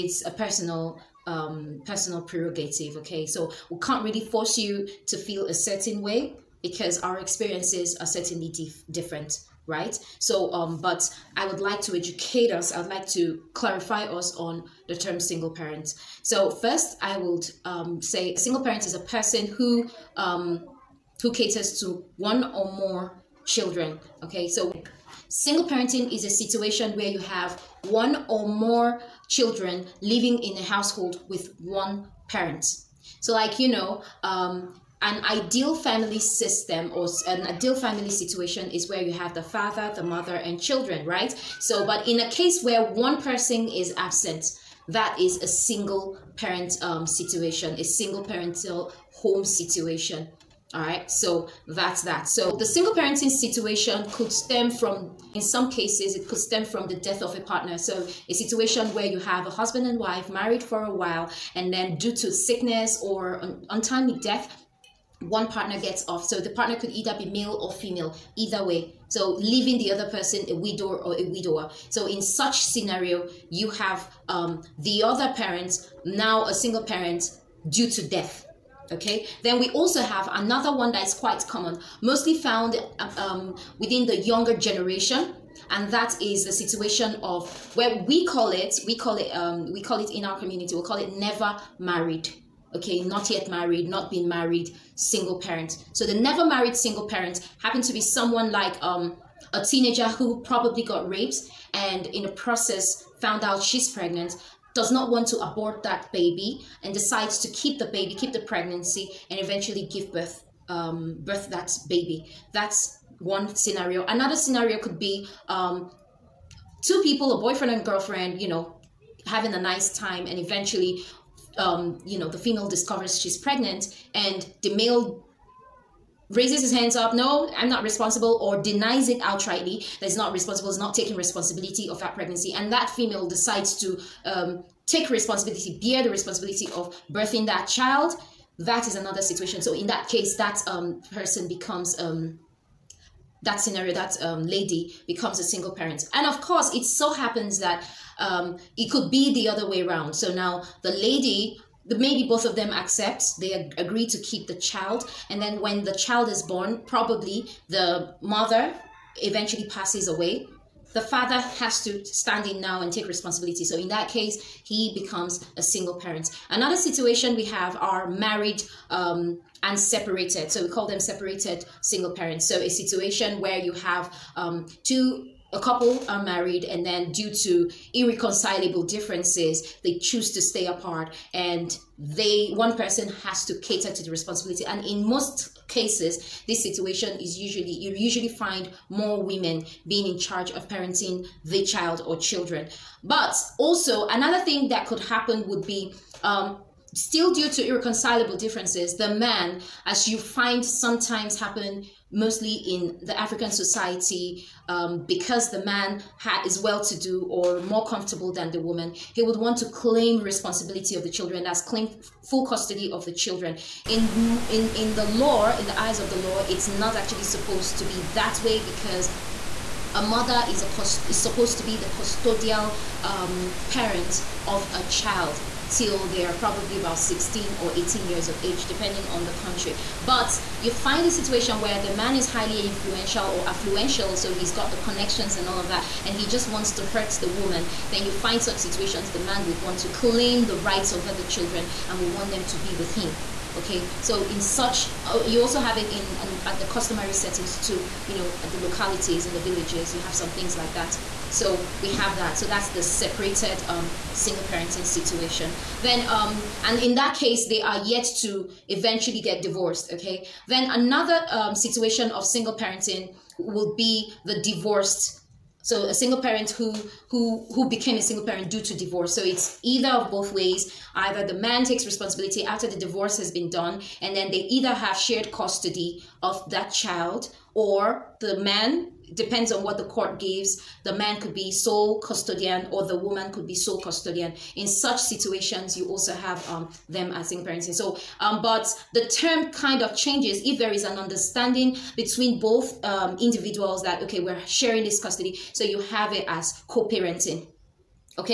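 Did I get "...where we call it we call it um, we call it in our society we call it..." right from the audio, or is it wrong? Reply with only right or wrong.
wrong.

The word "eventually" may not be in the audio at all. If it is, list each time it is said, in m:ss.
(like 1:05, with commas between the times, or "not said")
1:49, 2:00, 2:39, 4:18.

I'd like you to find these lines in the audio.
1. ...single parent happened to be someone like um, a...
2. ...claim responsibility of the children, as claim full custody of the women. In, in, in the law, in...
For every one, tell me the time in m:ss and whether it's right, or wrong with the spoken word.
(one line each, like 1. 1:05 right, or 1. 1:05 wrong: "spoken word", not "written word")
1. 1:36 right
2. 3:29 wrong: "children", not "women".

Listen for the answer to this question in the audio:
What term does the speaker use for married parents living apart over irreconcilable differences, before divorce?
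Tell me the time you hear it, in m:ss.
2:51.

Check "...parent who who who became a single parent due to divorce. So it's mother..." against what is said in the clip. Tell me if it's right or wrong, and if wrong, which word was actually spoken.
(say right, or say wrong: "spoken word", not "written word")
wrong: "either", not "mother".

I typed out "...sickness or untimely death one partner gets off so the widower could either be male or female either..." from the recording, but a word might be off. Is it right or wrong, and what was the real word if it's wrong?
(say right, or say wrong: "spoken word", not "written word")
wrong: "partner", not "widower".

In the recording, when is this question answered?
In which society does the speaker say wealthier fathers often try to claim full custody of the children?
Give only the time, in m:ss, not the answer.
3:23.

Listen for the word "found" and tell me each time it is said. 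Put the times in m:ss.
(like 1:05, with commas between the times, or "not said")
1:22, 1:43.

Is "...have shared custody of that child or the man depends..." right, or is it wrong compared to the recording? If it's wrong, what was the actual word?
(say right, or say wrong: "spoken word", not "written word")
right.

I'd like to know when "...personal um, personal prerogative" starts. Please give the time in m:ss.
0:00.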